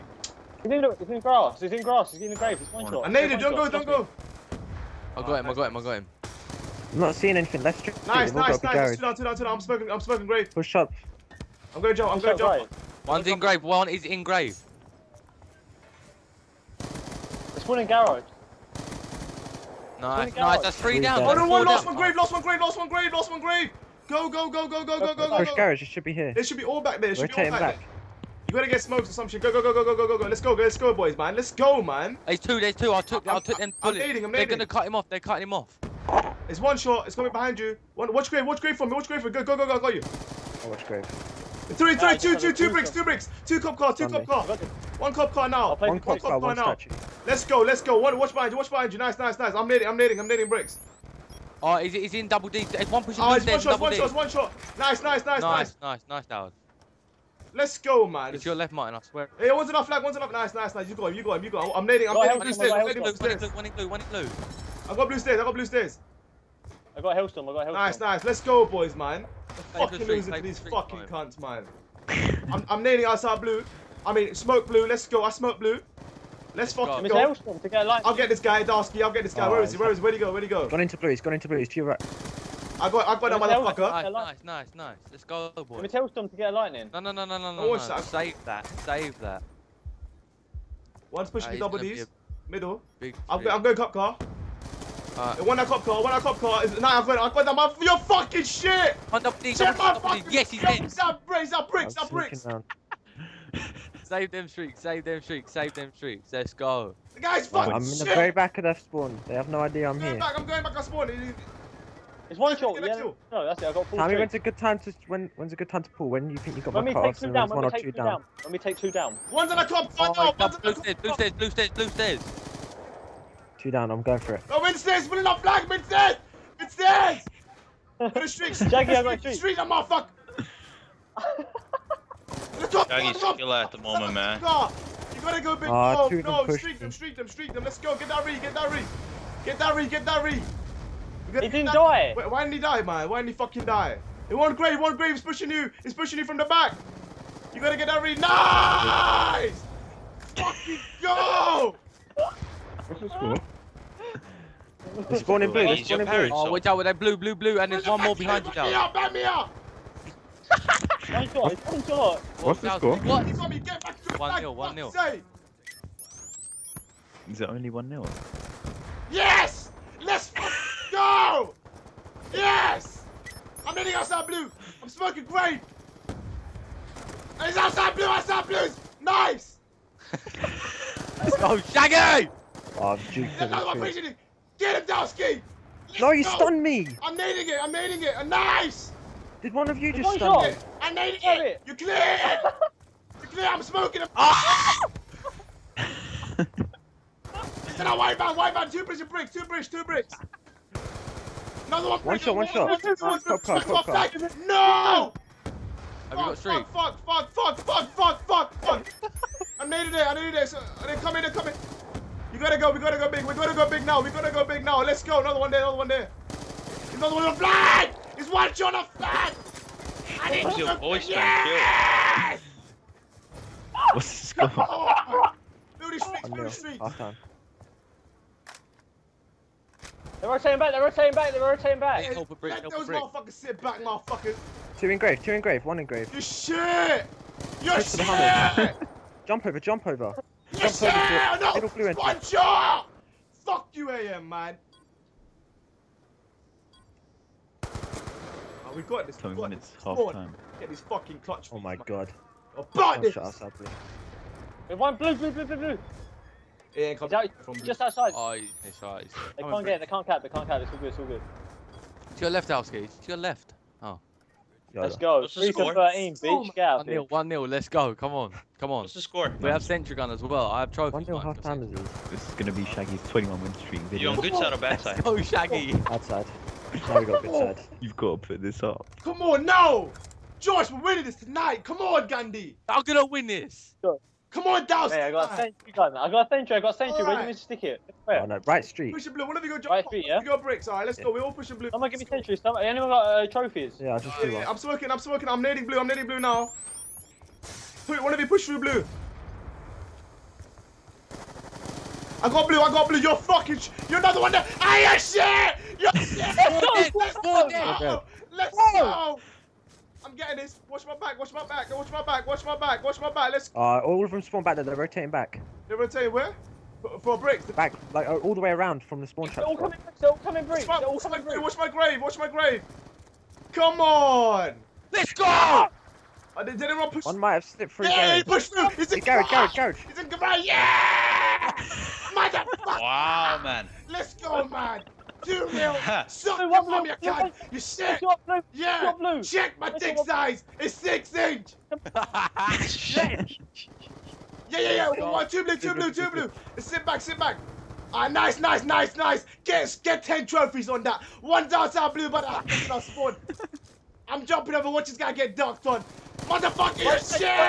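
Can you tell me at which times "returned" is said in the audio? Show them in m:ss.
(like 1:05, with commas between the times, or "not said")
not said.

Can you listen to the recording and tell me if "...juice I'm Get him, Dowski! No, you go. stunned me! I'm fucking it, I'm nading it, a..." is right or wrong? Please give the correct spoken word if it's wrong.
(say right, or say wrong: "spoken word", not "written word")
wrong: "nading", not "fucking".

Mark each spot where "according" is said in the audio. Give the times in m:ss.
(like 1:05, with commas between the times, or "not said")
not said.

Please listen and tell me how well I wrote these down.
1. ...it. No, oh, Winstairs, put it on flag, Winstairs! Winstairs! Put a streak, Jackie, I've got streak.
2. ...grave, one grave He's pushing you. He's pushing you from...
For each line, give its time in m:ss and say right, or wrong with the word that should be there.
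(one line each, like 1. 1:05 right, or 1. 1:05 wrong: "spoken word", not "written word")
1. 2:04 right
2. 2:24 right.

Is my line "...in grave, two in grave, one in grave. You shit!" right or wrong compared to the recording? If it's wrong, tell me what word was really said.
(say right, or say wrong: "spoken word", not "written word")
right.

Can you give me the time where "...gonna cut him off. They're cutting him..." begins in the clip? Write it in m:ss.
0:34.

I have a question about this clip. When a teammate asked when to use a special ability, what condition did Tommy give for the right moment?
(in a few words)
When we take two down.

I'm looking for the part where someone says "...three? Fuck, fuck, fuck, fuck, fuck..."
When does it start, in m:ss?
3:26.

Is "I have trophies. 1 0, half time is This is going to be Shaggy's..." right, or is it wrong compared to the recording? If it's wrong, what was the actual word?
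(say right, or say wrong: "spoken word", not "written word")
right.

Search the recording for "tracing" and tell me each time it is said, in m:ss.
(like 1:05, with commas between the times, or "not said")
not said.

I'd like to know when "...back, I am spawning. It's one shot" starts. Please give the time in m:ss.
1:50.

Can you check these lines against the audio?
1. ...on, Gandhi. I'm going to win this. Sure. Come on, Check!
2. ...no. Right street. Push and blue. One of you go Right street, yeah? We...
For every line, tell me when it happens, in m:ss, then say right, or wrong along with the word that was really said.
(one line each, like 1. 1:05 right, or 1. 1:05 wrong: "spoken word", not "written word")
1. 4:41 wrong: "Douse", not "Check"
2. 4:48 right.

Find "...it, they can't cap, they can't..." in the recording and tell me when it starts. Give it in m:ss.
4:19.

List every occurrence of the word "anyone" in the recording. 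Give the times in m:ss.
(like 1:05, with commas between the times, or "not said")
4:52, 5:26.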